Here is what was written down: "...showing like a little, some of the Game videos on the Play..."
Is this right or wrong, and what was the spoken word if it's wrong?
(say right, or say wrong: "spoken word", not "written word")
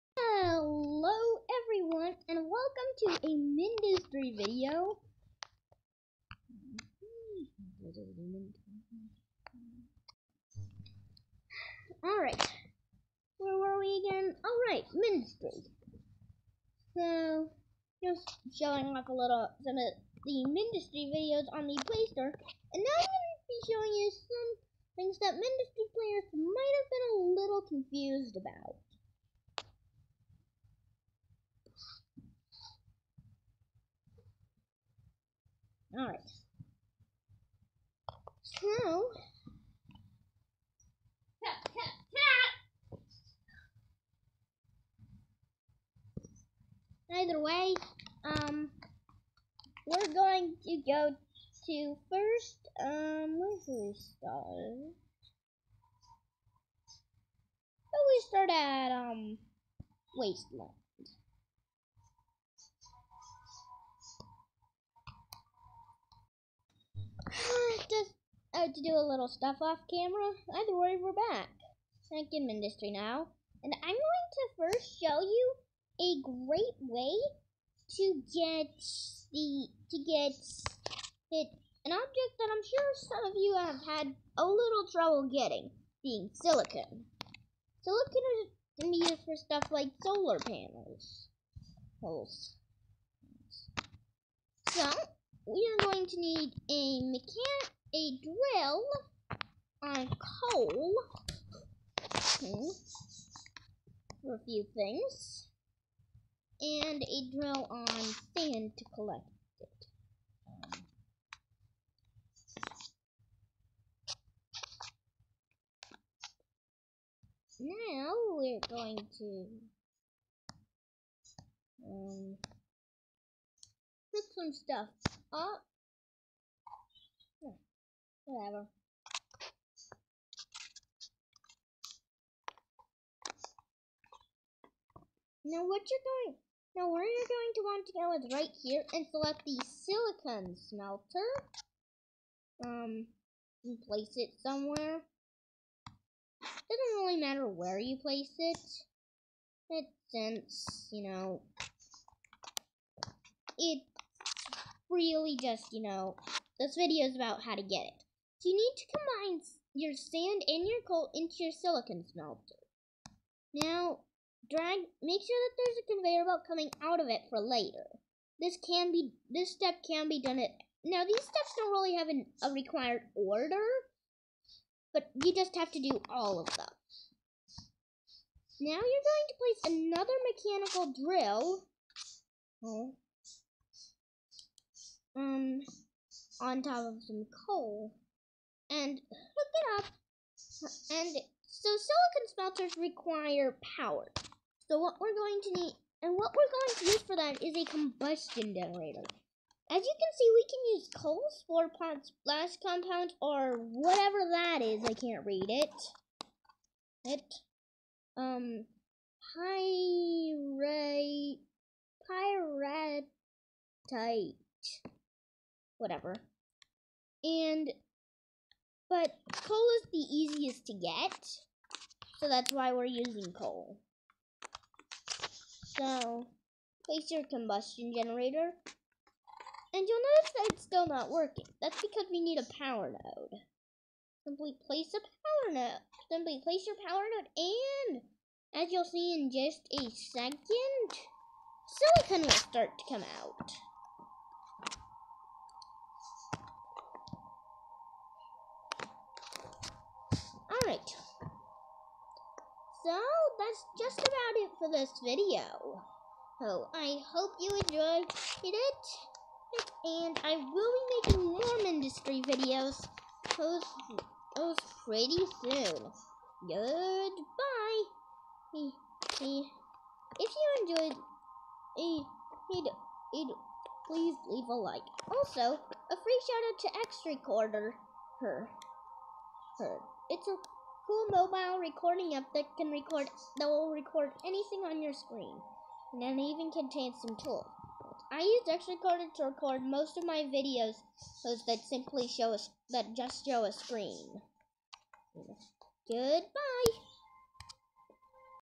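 wrong: "Mindustry", not "Game".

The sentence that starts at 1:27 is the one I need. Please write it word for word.
Silicon is, can be used for stuff like solar panels.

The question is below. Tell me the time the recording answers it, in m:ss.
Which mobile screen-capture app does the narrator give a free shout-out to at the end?
4:36.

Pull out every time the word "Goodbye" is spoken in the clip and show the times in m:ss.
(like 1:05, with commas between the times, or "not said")
4:26, 4:55.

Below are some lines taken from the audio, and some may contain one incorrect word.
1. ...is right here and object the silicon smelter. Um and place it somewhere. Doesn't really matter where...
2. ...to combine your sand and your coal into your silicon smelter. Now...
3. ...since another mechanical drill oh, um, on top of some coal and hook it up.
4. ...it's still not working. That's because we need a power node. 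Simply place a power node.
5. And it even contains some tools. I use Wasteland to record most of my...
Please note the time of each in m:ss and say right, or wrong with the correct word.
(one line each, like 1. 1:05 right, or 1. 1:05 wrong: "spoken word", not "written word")
1. 2:18 wrong: "select", not "object"
2. 2:38 right
3. 2:59 wrong: "place", not "since"
4. 3:50 right
5. 4:45 wrong: "XRecorder", not "Wasteland".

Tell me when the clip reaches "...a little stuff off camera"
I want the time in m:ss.
1:08.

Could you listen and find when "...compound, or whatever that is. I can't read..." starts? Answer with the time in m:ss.
3:22.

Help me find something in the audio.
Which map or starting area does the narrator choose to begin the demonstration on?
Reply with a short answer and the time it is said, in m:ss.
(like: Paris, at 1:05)
Wasteland, at 1:00.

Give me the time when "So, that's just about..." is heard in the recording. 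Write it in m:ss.
4:12.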